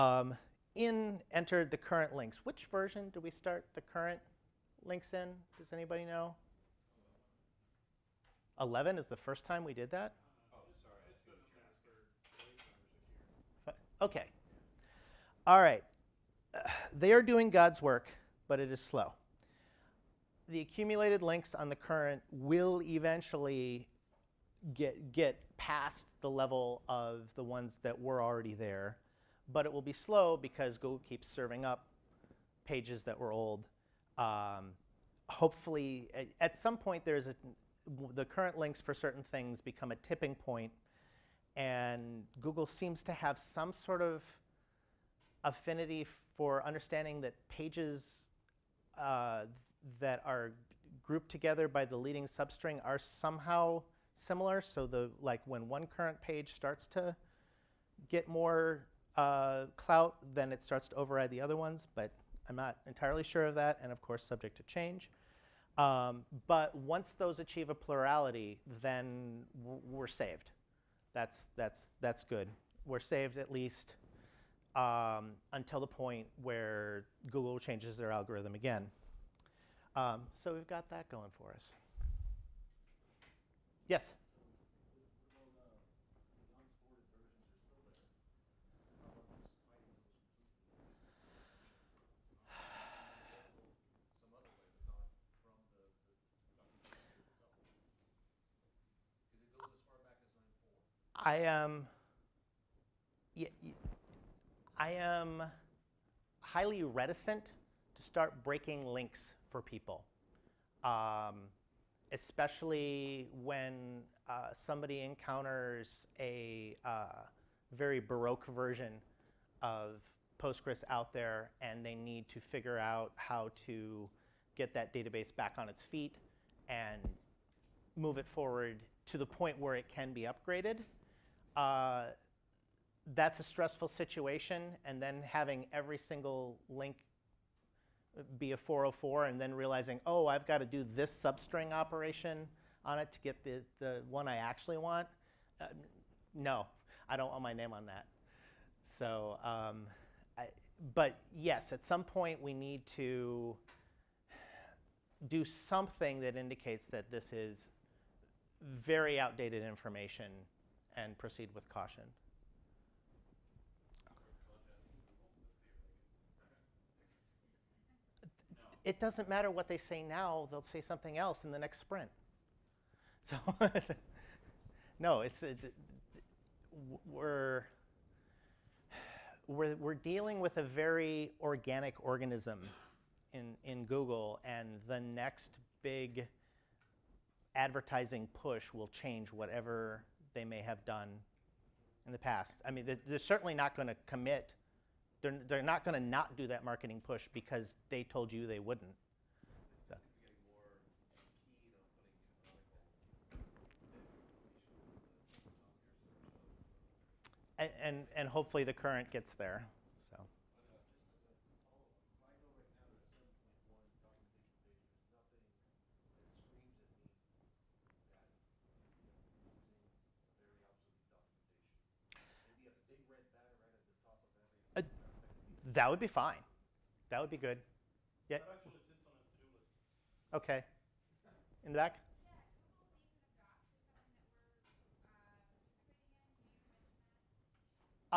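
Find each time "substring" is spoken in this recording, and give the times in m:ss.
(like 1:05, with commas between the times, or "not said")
0:52, 2:21.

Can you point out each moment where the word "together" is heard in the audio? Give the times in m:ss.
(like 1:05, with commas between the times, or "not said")
0:51.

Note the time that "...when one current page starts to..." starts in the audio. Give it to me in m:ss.
0:55.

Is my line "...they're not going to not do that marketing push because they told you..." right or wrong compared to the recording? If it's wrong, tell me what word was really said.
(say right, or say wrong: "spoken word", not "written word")
right.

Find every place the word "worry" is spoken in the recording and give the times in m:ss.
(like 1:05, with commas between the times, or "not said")
not said.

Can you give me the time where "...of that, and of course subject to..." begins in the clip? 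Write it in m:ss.
1:03.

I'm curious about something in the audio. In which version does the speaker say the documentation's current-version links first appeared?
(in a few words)
11.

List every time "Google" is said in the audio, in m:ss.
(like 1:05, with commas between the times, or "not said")
0:30, 0:42, 1:17, 3:03.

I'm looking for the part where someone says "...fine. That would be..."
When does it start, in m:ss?
3:46.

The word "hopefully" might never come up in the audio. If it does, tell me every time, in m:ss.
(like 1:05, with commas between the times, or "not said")
0:35, 3:28.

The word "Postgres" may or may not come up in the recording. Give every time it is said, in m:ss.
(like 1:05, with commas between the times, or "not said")
2:00.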